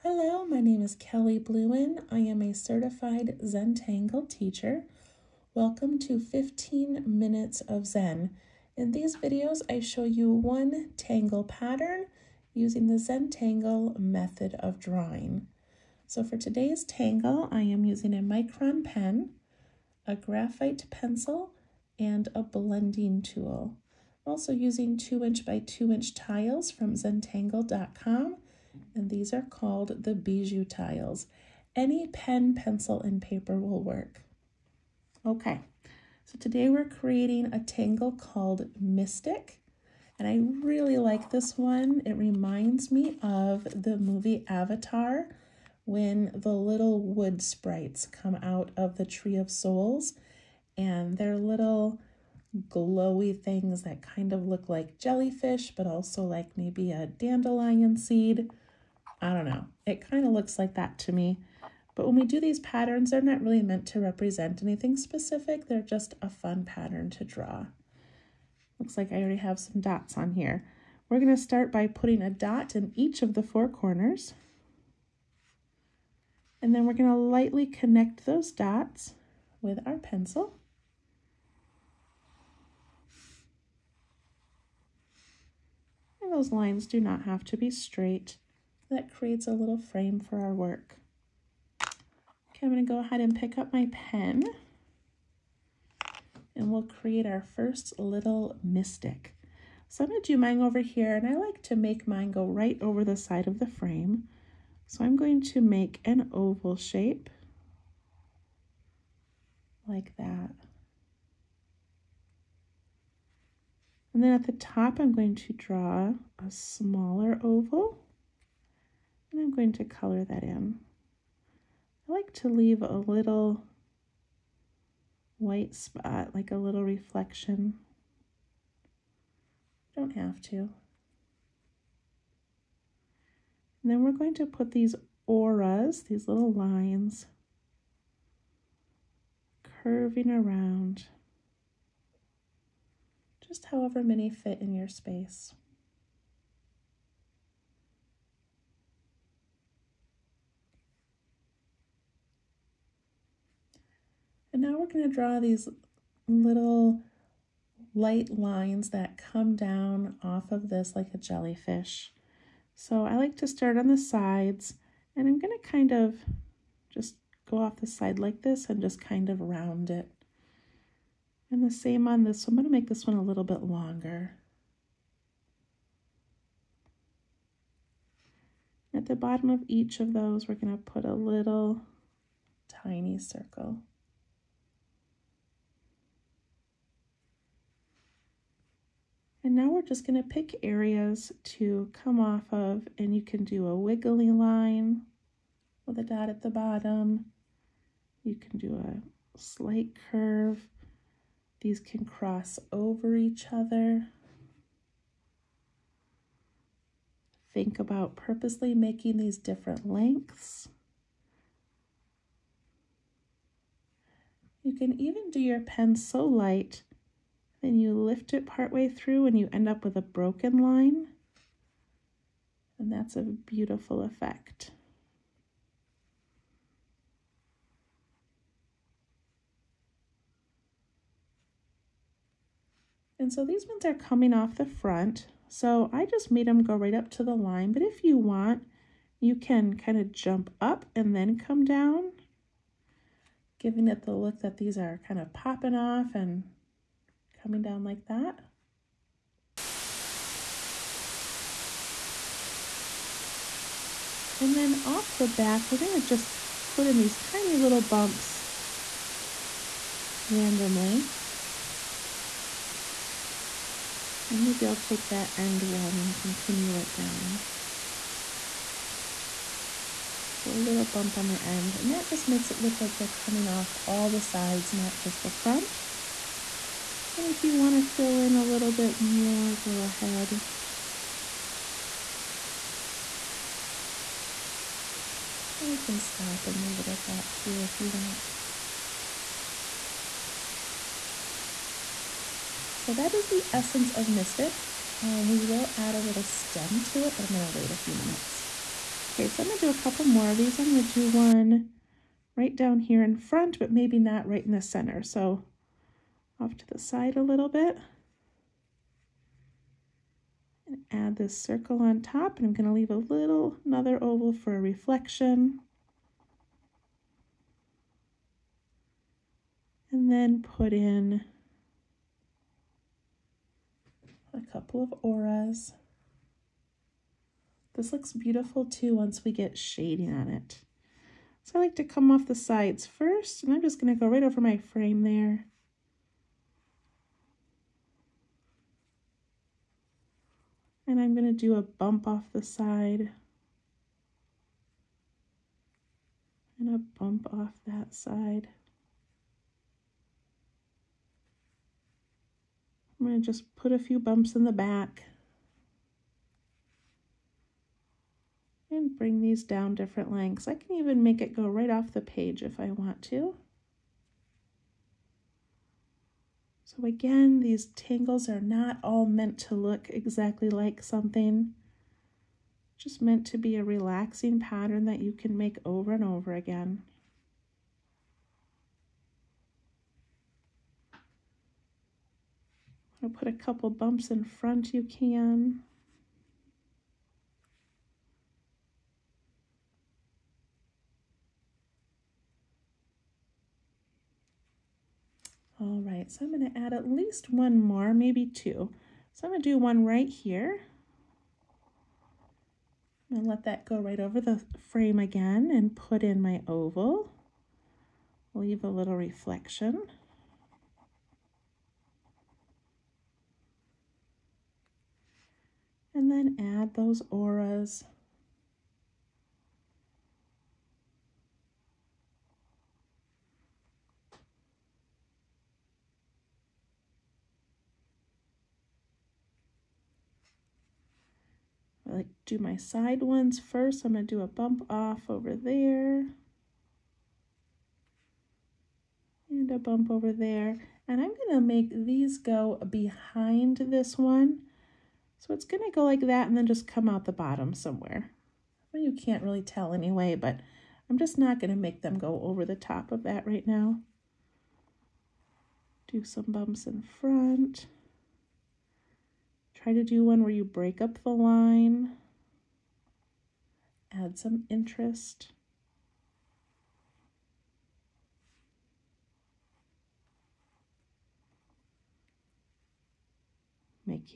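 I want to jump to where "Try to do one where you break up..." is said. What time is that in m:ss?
7:39.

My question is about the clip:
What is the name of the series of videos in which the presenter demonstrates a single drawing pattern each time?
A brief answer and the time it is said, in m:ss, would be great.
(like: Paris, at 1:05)
15 Minutes of Zen, at 0:06.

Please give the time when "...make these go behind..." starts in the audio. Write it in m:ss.
7:21.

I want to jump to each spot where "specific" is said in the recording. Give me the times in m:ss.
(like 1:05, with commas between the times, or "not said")
1:04.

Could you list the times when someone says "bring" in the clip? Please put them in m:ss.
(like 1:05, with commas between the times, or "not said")
5:58.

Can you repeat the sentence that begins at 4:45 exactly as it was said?
And we can stop and leave it at that too if you want.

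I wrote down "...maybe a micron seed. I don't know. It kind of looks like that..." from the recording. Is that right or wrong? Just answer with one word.
wrong.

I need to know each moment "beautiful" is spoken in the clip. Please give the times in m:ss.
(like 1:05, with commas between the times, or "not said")
3:43, 5:28.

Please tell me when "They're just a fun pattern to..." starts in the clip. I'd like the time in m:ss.
1:05.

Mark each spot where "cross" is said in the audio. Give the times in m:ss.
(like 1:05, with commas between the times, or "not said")
3:22.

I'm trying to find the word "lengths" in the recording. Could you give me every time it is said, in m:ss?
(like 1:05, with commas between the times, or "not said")
3:29, 6:00.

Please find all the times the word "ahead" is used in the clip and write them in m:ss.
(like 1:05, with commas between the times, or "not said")
1:32, 4:39.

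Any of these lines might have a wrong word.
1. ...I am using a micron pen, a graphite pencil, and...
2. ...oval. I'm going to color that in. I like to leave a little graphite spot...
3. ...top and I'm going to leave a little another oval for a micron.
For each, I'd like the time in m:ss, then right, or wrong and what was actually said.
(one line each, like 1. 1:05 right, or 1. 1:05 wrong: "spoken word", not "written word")
1. 0:17 right
2. 1:57 wrong: "white", not "graphite"
3. 5:12 wrong: "reflection", not "micron".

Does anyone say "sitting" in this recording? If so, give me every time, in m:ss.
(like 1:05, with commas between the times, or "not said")
not said.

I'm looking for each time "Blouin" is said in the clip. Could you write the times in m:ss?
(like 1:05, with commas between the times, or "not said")
0:01.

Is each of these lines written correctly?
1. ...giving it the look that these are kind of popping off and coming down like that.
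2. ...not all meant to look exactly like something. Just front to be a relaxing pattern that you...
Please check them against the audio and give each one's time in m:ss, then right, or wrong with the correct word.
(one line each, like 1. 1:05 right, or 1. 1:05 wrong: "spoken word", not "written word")
1. 4:03 right
2. 6:08 wrong: "meant", not "front".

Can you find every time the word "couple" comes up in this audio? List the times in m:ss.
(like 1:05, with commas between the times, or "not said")
4:59, 5:24, 6:23.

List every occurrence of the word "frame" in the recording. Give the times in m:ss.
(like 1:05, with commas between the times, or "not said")
1:29, 1:43, 5:34, 6:44.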